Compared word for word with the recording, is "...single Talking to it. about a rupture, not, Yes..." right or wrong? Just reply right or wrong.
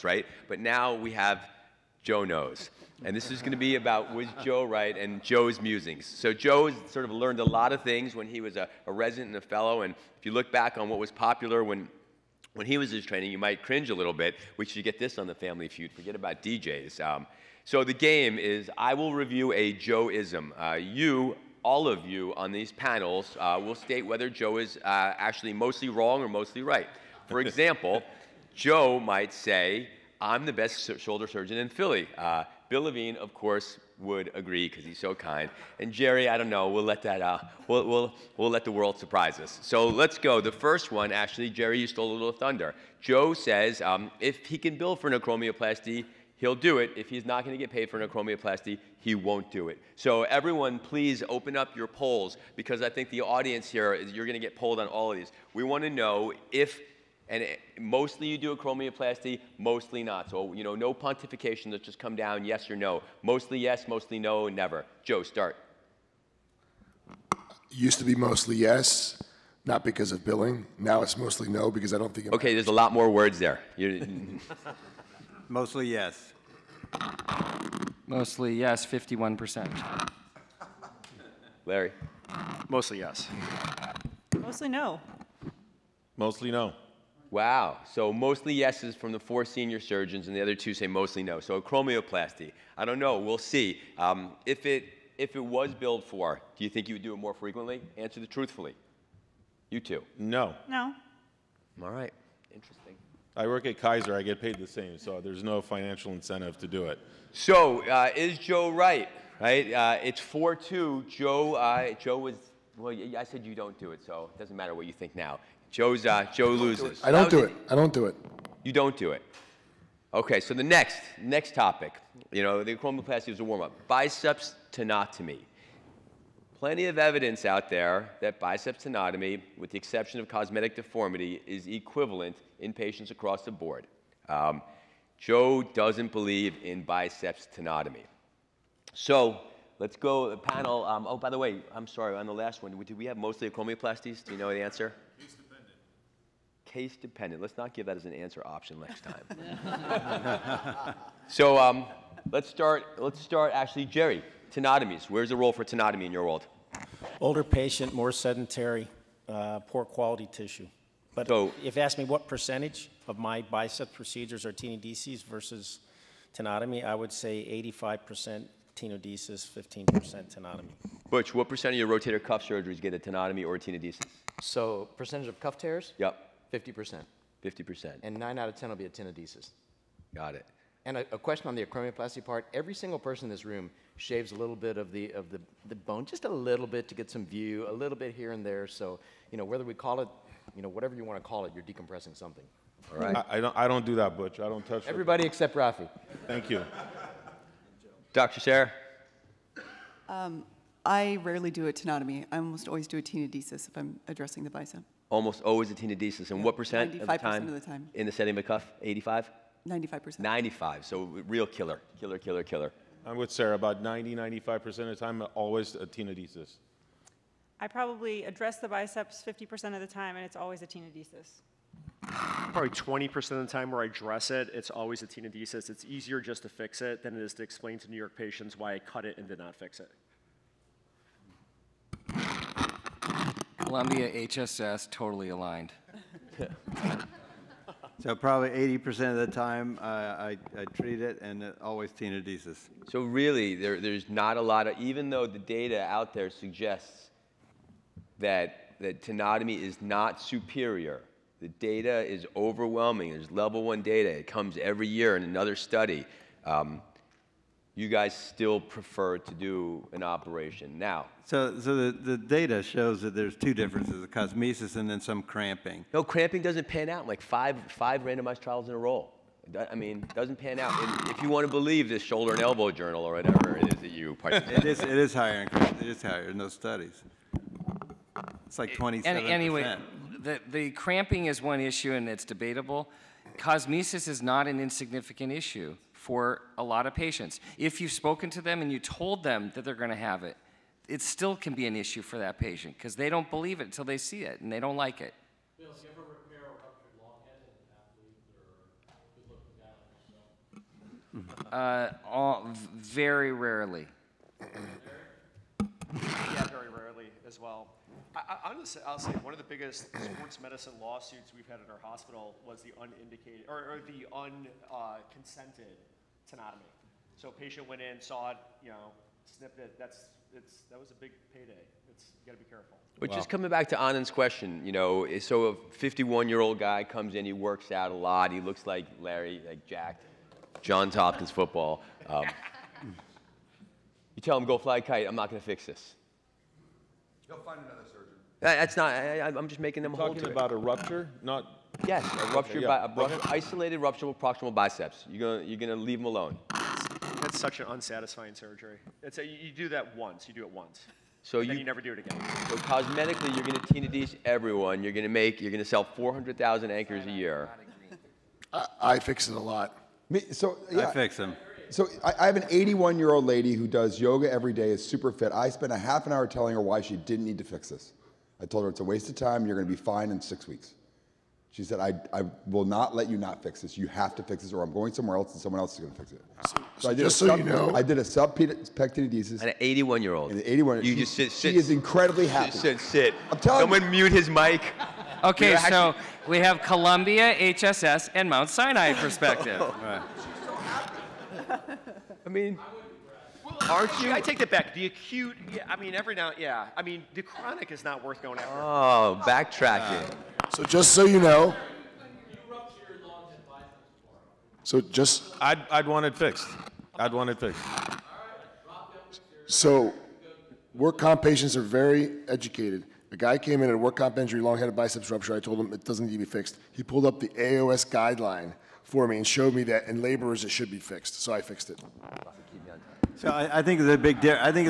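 wrong.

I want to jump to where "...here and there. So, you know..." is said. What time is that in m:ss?
3:08.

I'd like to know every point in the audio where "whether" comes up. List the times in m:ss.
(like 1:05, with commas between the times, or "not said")
0:24, 3:09.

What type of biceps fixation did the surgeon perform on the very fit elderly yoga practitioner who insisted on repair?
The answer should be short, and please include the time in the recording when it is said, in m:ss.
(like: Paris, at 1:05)
Subpec tenodesis, at 6:18.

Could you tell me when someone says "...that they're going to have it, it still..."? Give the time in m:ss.
4:49.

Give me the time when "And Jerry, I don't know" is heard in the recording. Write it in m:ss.
0:35.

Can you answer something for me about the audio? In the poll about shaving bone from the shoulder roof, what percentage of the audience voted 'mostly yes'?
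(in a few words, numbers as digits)
51%.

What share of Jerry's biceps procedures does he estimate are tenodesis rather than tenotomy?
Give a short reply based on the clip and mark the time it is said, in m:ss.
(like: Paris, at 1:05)
85%, at 2:47.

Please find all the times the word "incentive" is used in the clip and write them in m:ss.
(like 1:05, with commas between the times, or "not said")
1:46.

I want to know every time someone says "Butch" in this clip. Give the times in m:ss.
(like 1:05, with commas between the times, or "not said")
2:51, 3:14.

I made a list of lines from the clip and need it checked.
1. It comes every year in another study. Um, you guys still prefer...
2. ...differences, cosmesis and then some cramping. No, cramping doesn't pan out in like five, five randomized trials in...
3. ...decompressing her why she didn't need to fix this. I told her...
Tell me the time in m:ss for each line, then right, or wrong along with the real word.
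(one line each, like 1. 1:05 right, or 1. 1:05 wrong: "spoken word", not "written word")
1. 4:14 right
2. 4:23 right
3. 6:06 wrong: "telling", not "decompressing".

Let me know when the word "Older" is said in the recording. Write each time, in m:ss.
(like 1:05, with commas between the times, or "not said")
2:37.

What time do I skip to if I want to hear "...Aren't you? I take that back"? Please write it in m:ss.
6:33.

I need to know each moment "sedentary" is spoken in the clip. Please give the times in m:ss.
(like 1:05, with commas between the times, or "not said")
2:38.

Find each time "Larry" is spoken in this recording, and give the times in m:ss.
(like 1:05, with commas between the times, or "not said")
1:21, 5:28.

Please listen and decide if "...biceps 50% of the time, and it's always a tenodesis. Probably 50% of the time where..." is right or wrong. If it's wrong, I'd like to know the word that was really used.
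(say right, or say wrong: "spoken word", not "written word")
wrong: "20", not "50".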